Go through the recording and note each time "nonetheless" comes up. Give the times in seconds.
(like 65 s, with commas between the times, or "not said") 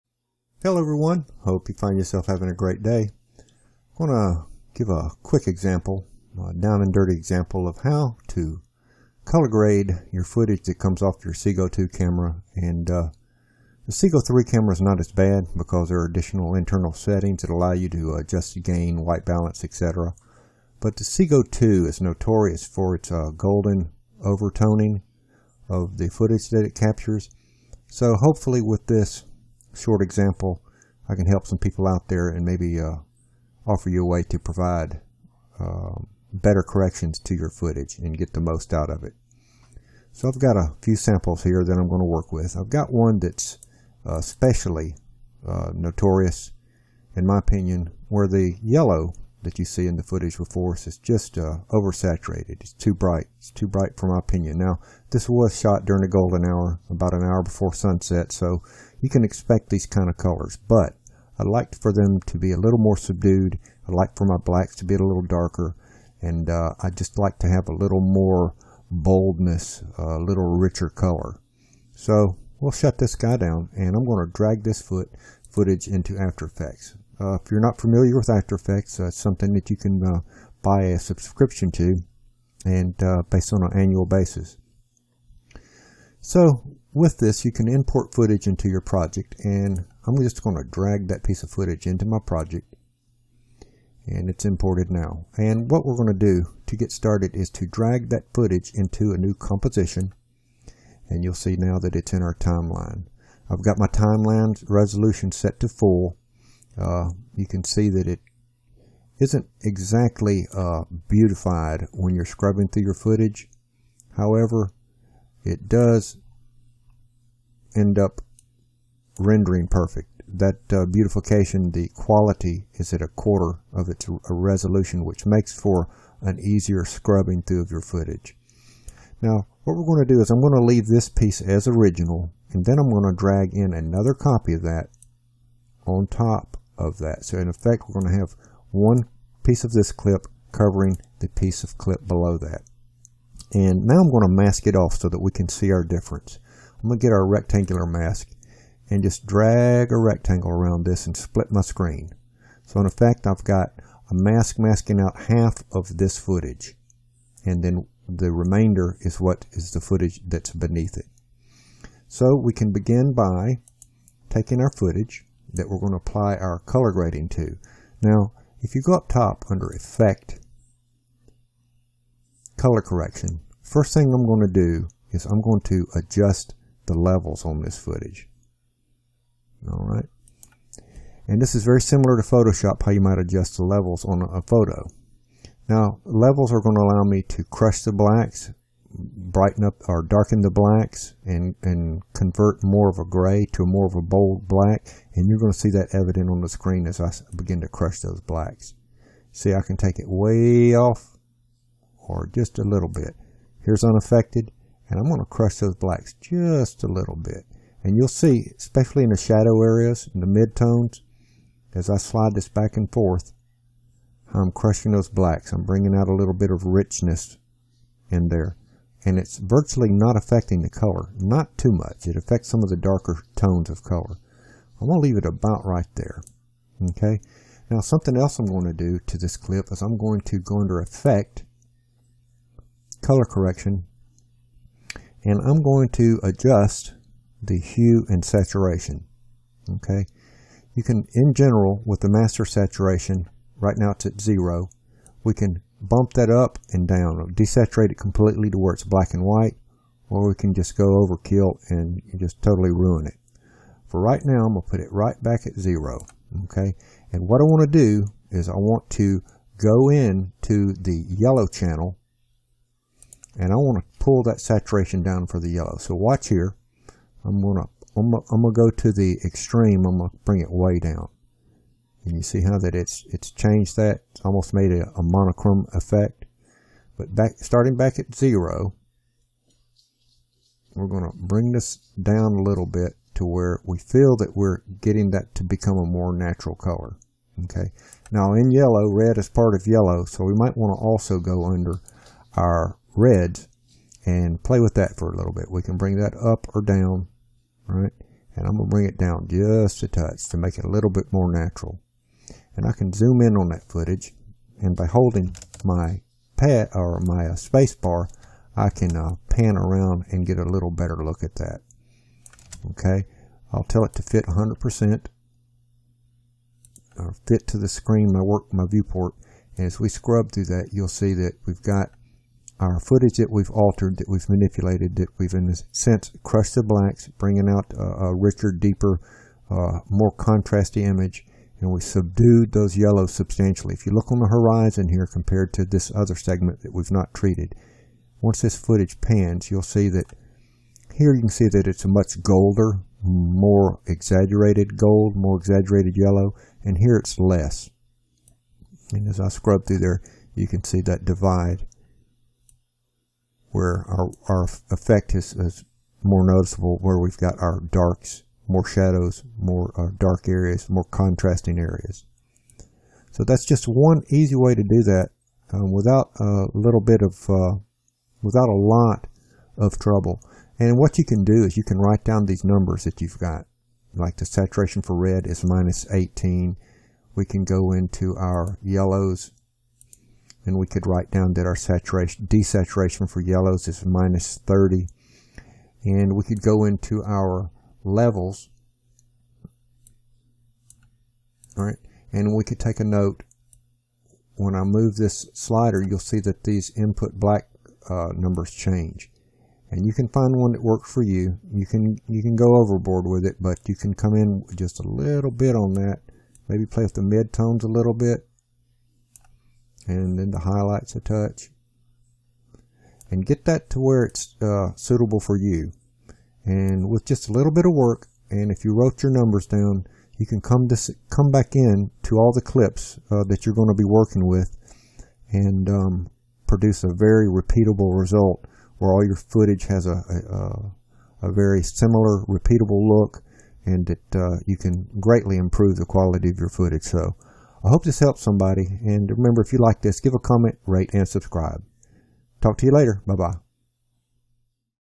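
not said.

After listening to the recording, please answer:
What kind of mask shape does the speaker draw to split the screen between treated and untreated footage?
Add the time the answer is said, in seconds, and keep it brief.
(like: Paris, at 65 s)
rectangular, at 147 s.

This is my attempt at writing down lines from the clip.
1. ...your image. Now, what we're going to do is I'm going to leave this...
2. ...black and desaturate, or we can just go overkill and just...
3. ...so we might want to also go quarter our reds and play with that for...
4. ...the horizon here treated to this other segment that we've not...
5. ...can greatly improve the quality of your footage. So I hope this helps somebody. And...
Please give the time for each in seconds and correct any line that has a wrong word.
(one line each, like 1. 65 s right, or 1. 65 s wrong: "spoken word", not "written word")
1. 127 s wrong: "footage", not "image"
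2. 248 s wrong: "white", not "desaturate"
3. 290 s wrong: "under", not "quarter"
4. 334 s wrong: "compared", not "treated"
5. 434 s right.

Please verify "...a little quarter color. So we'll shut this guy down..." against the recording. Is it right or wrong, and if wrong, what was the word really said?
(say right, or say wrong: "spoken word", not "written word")
wrong: "richer", not "quarter".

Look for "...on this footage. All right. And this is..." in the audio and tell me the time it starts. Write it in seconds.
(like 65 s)
177 s.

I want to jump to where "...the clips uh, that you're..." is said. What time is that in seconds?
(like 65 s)
422 s.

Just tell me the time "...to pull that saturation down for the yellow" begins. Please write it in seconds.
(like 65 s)
263 s.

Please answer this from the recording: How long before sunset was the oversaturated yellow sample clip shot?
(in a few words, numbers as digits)
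about an hour.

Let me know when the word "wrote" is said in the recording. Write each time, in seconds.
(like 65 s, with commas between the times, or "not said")
418 s.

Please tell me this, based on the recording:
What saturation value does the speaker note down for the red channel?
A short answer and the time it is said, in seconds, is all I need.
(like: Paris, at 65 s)
-18, at 375 s.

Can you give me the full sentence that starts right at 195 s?
And you're going to see that evident on the screen as I begin to crush those blacks.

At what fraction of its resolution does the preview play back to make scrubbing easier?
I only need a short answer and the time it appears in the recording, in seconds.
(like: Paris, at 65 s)
a quarter, at 123 s.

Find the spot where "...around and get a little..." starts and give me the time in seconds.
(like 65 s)
309 s.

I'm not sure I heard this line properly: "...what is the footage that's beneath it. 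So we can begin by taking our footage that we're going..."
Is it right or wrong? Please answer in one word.
right.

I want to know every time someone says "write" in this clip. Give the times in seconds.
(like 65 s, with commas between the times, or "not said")
371 s, 380 s.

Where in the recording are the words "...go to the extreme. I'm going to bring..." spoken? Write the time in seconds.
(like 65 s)
268 s.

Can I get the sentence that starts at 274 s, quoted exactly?
It's almost made a, a monochrome effect.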